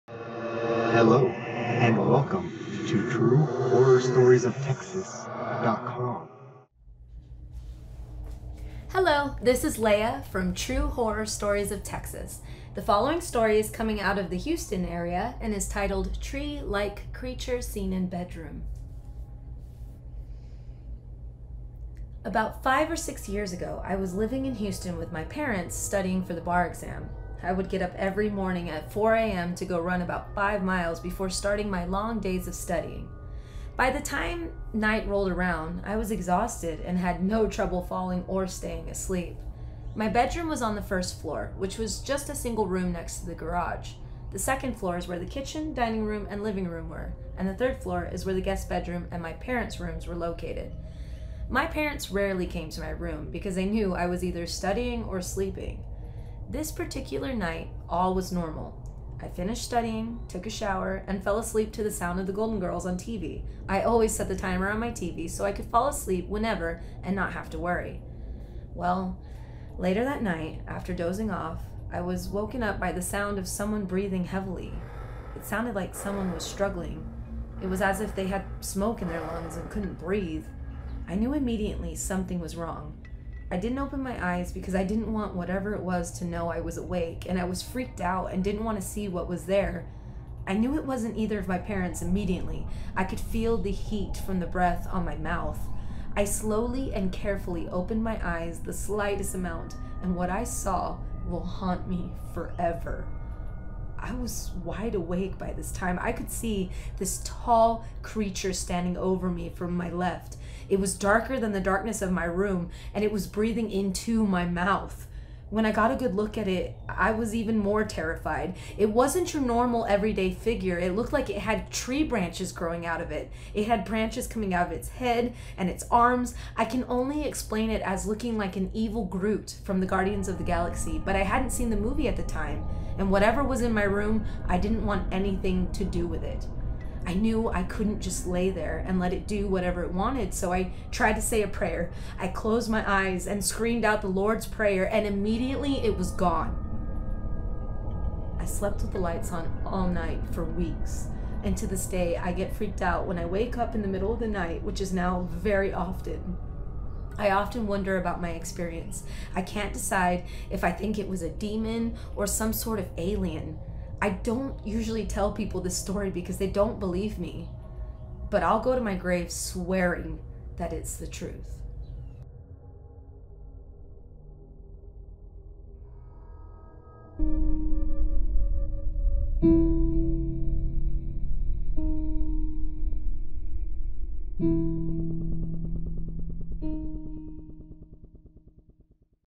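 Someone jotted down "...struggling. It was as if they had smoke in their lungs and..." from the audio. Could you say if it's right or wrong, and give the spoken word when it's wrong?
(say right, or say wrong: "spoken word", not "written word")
right.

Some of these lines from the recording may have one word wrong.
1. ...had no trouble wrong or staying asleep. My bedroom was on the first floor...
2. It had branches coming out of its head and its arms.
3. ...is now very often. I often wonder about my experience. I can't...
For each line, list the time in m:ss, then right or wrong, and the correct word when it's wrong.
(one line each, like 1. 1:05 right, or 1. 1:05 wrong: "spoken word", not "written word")
1. 0:36 wrong: "falling", not "wrong"
2. 2:03 right
3. 2:34 right.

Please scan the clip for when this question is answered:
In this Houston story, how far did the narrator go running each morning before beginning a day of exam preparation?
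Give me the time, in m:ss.
0:30.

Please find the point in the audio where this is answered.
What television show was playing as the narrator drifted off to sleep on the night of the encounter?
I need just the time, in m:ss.
1:02.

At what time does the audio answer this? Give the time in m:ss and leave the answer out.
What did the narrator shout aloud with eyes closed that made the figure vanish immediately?
2:24.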